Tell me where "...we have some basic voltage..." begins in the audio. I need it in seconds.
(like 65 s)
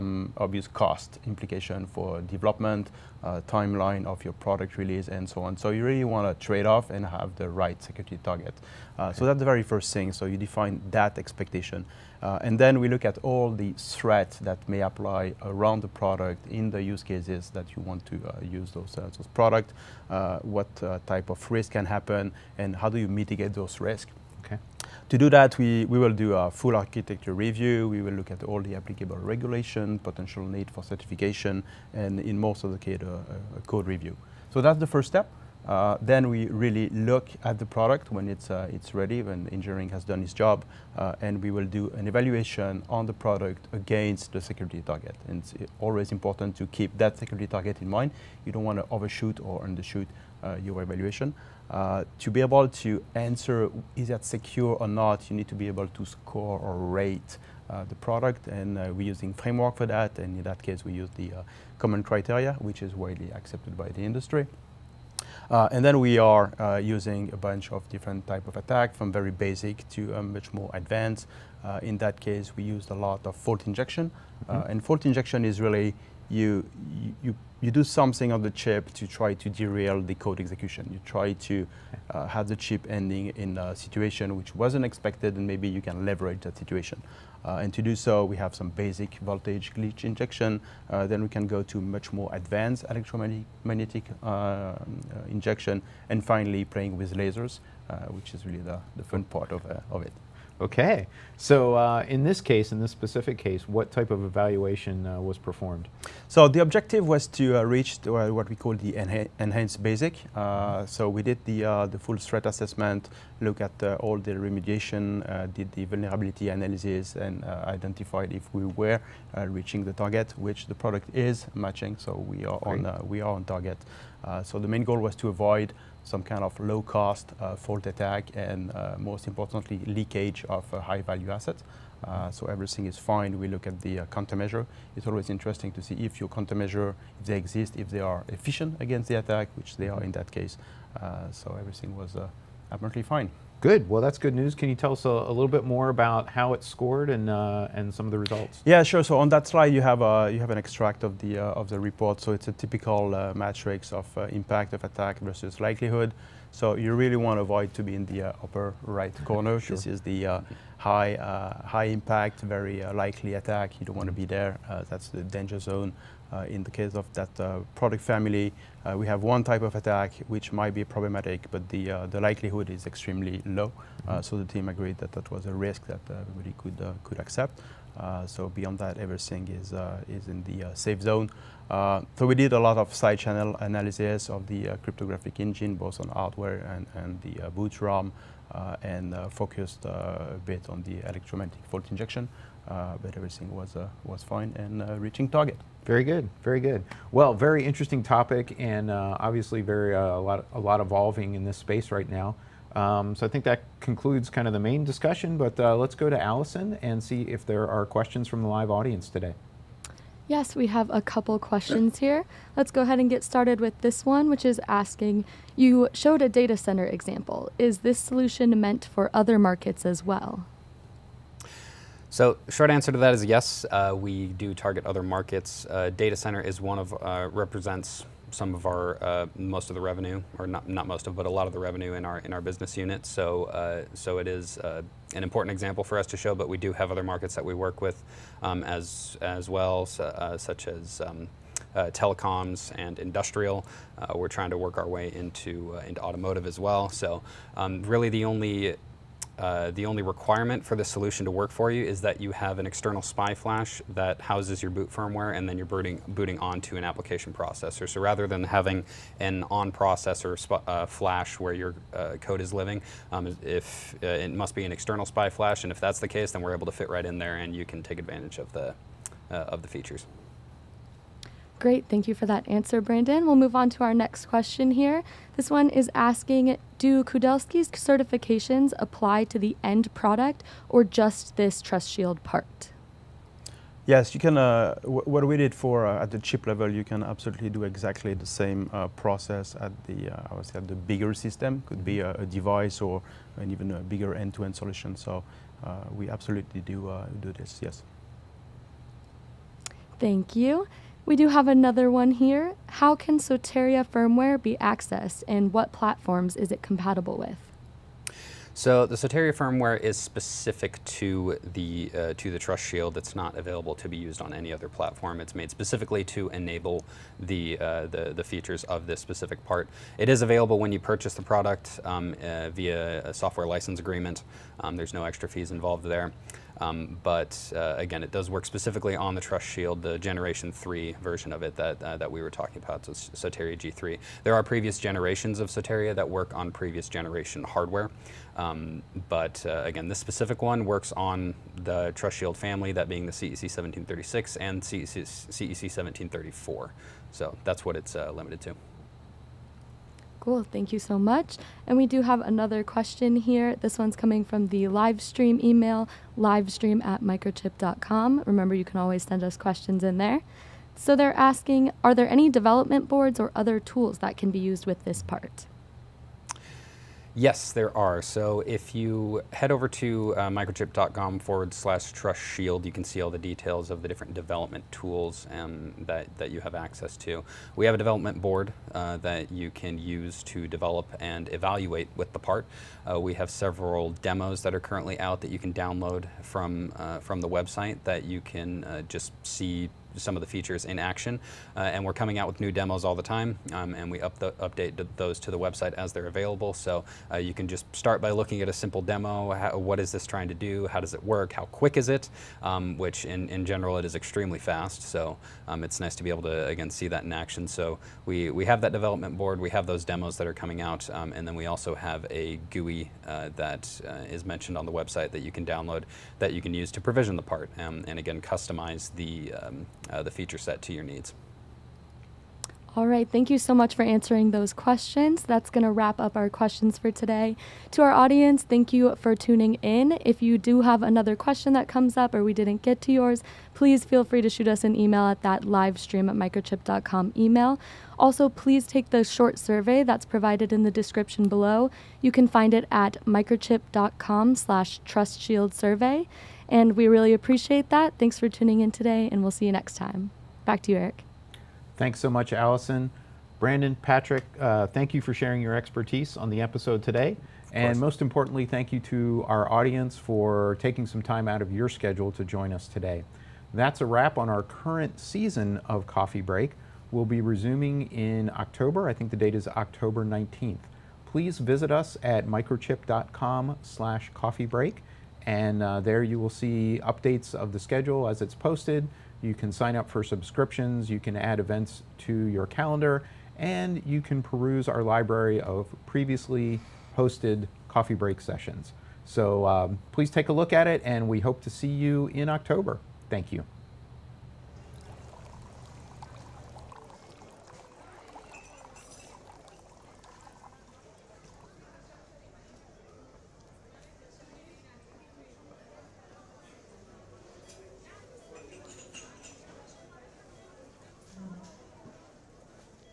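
88 s.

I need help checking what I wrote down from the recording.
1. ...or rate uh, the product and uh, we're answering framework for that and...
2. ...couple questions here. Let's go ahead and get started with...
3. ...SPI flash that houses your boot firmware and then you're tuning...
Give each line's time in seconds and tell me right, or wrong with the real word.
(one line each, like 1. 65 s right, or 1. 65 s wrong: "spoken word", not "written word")
1. 56 s wrong: "using", not "answering"
2. 211 s right
3. 253 s wrong: "booting", not "tuning".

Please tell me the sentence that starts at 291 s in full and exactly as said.
Could be a, a device or an even a bigger end-to-end -end solution.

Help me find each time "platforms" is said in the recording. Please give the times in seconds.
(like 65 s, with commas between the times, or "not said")
305 s, 314 s.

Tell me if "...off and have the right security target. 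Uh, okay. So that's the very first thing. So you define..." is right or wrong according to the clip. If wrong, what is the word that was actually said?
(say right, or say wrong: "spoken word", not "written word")
right.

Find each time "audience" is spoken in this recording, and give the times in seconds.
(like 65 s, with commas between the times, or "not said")
208 s, 427 s, 459 s.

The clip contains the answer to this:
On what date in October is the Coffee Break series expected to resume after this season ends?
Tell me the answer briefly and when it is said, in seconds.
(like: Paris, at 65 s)
October 19, at 469 s.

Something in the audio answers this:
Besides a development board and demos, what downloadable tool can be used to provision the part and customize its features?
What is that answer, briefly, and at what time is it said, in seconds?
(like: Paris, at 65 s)
A GUI, at 412 s.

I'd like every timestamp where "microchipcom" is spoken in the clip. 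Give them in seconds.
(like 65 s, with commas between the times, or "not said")
357 s, 370 s, 436 s, 443 s, 472 s.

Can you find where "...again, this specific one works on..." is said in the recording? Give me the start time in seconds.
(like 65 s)
339 s.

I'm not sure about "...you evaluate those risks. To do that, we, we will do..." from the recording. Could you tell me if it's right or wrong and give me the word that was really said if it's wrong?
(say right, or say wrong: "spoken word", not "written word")
wrong: "mitigate", not "evaluate".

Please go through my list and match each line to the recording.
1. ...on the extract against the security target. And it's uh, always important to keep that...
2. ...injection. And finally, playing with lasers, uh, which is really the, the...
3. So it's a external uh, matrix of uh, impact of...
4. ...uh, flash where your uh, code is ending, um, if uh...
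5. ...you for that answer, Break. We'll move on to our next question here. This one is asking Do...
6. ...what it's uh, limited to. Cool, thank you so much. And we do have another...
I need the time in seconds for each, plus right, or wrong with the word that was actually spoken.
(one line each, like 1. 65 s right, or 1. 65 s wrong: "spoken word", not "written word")
1. 42 s wrong: "product", not "extract"
2. 95 s right
3. 152 s wrong: "typical", not "external"
4. 260 s wrong: "living", not "ending"
5. 272 s wrong: "Brandon", not "Break"
6. 347 s right.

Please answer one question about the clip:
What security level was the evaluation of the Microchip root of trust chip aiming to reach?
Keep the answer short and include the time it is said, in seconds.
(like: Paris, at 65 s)
Enhanced basic, at 109 s.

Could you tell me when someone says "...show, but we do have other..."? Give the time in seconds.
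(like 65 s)
236 s.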